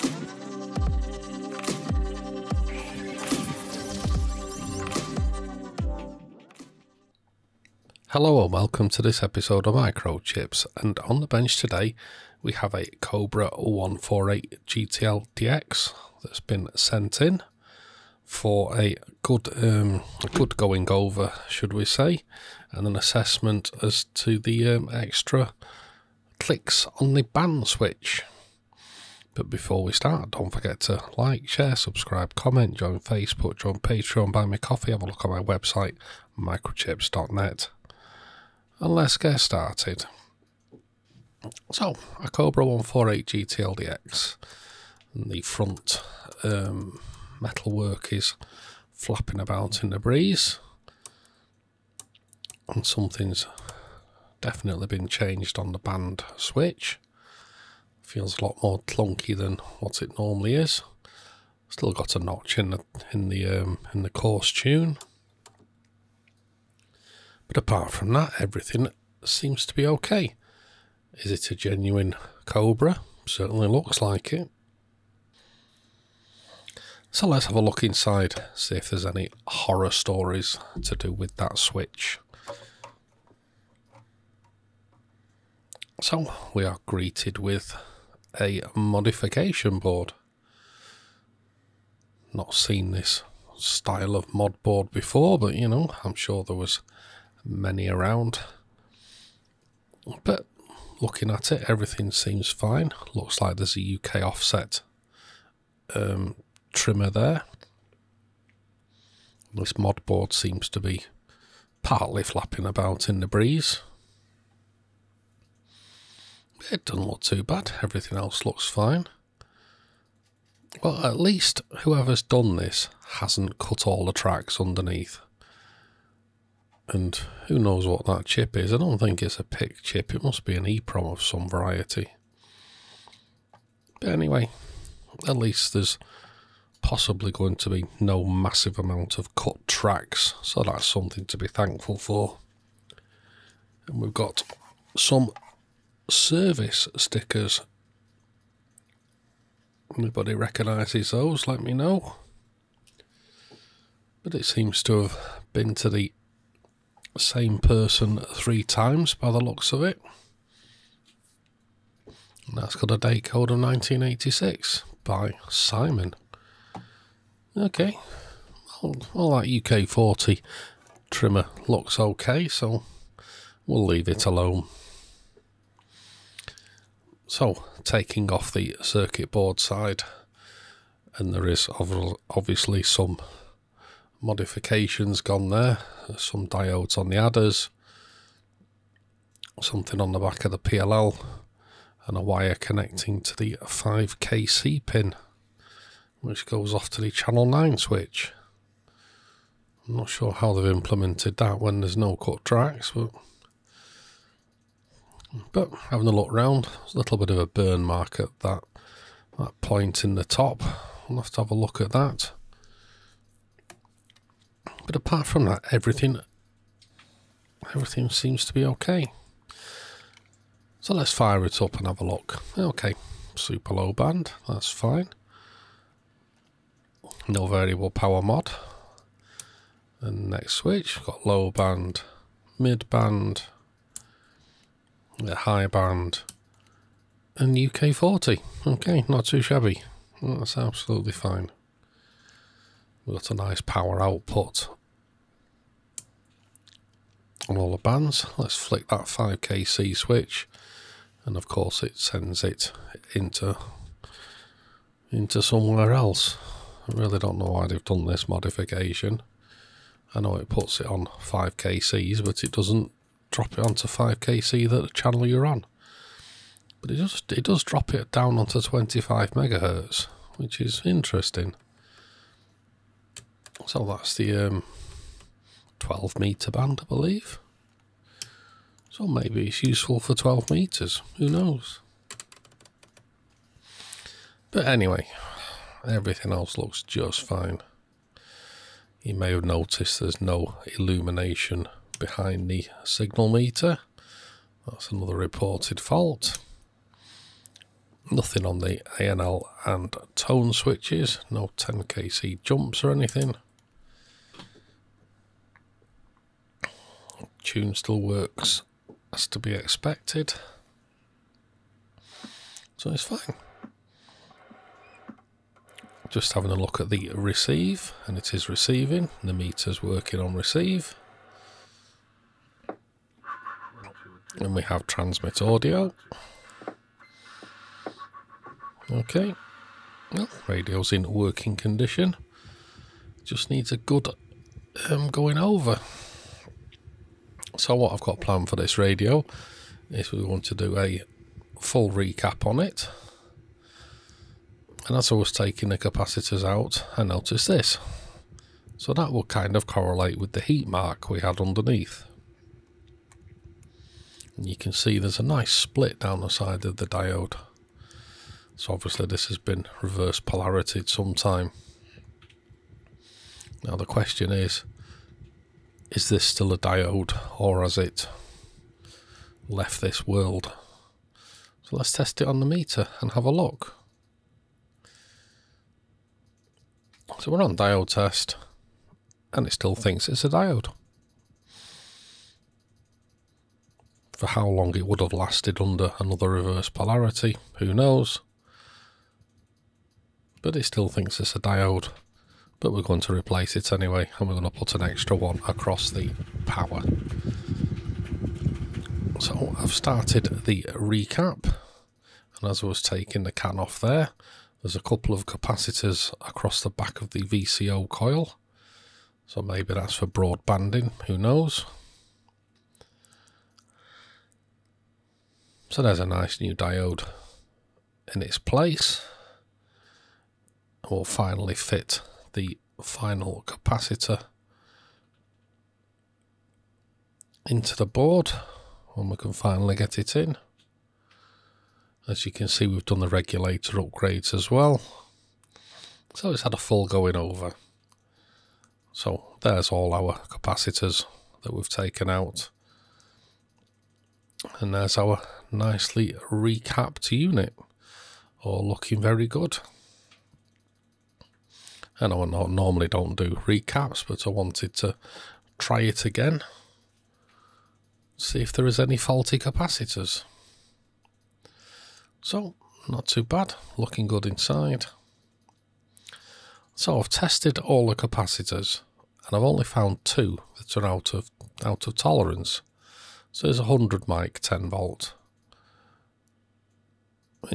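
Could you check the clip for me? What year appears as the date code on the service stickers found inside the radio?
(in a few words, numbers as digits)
1986.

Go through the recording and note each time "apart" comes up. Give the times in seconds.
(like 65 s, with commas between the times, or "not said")
67 s, 214 s.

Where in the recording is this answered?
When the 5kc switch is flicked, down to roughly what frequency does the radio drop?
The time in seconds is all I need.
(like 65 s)
268 s.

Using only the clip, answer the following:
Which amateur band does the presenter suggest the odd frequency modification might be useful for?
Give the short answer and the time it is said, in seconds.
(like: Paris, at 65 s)
12 metre band, at 275 s.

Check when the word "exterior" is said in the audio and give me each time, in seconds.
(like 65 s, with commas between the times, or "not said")
not said.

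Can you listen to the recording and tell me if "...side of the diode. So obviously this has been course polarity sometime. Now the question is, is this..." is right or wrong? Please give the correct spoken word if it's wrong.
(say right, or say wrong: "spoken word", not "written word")
wrong: "reverse", not "course".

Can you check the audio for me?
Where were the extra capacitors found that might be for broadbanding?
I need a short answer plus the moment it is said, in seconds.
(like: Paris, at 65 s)
Back of the VCO coil, at 406 s.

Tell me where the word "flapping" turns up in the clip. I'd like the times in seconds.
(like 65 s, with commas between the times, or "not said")
48 s, 112 s.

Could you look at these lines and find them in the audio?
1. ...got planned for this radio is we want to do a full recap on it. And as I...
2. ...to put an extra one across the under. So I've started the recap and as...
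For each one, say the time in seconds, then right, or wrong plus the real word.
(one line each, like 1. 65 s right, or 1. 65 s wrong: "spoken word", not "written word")
1. 338 s right
2. 394 s wrong: "power", not "under".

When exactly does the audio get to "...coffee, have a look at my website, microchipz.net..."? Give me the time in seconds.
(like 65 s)
34 s.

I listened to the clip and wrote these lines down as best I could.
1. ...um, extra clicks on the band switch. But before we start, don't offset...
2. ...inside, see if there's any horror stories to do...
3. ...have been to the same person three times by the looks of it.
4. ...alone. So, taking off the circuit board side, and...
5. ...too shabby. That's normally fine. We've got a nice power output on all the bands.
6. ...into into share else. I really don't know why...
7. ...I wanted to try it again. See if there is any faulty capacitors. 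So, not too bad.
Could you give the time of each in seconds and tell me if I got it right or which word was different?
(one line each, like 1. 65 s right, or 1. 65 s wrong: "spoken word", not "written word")
1. 24 s wrong: "forget", not "offset"
2. 77 s right
3. 155 s right
4. 174 s right
5. 239 s wrong: "absolutely", not "normally"
6. 253 s wrong: "somewhere", not "share"
7. 454 s right.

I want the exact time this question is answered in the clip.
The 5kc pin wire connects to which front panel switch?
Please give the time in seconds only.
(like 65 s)
197 s.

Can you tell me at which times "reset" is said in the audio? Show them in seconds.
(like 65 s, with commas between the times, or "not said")
not said.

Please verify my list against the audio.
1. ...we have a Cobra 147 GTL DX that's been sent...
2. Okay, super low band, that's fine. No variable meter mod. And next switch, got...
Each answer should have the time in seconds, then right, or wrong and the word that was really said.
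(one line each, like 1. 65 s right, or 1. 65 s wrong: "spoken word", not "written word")
1. 12 s wrong: "148", not "147"
2. 222 s wrong: "power", not "meter".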